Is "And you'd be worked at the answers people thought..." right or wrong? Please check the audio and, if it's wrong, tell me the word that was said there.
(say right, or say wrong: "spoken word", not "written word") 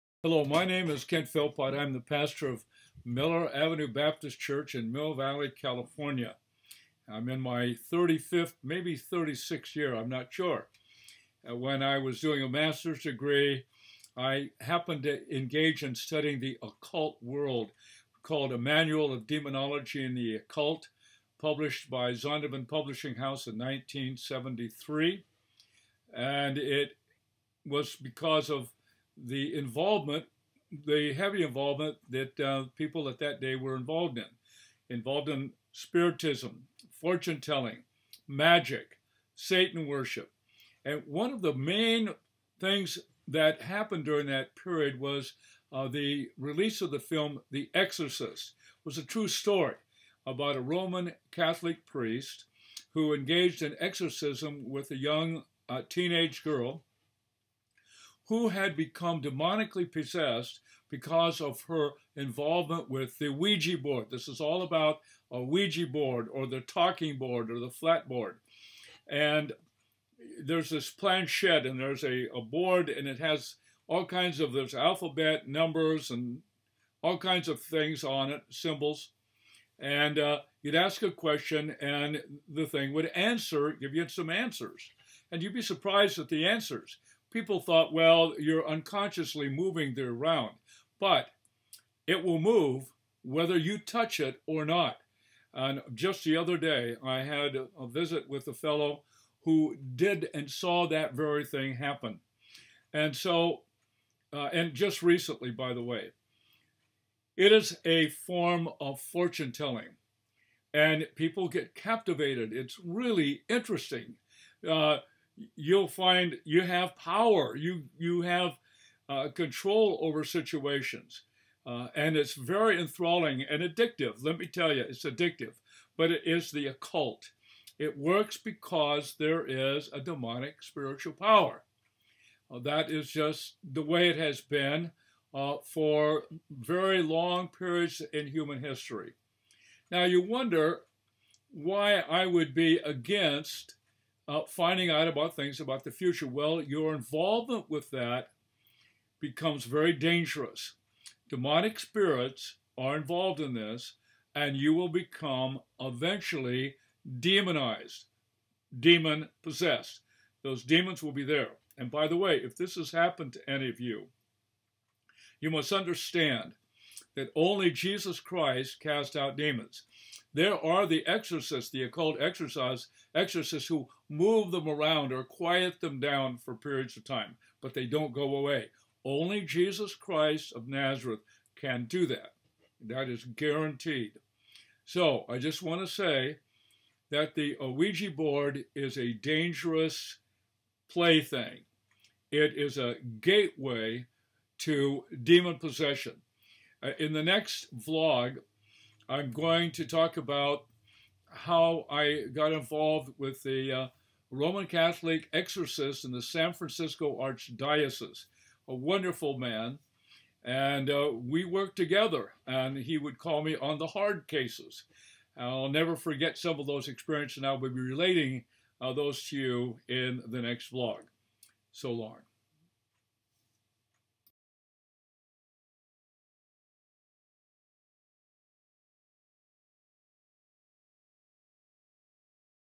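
wrong: "surprised", not "worked".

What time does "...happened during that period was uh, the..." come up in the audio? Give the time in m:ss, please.
0:43.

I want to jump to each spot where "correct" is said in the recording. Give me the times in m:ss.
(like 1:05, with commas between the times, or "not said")
not said.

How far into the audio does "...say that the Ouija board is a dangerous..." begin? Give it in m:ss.
3:05.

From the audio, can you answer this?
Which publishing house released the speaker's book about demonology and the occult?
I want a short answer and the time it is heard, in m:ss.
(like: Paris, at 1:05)
Zondervan, at 0:22.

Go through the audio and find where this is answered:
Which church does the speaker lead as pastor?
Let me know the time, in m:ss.
0:03.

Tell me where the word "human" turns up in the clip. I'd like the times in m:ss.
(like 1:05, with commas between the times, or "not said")
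2:18.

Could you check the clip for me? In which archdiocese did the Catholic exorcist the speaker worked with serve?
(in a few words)
San Francisco.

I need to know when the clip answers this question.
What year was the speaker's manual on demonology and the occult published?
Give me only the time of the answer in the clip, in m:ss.
0:23.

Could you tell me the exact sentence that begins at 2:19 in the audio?
Now you wonder why I would be against uh, finding out about things about the future.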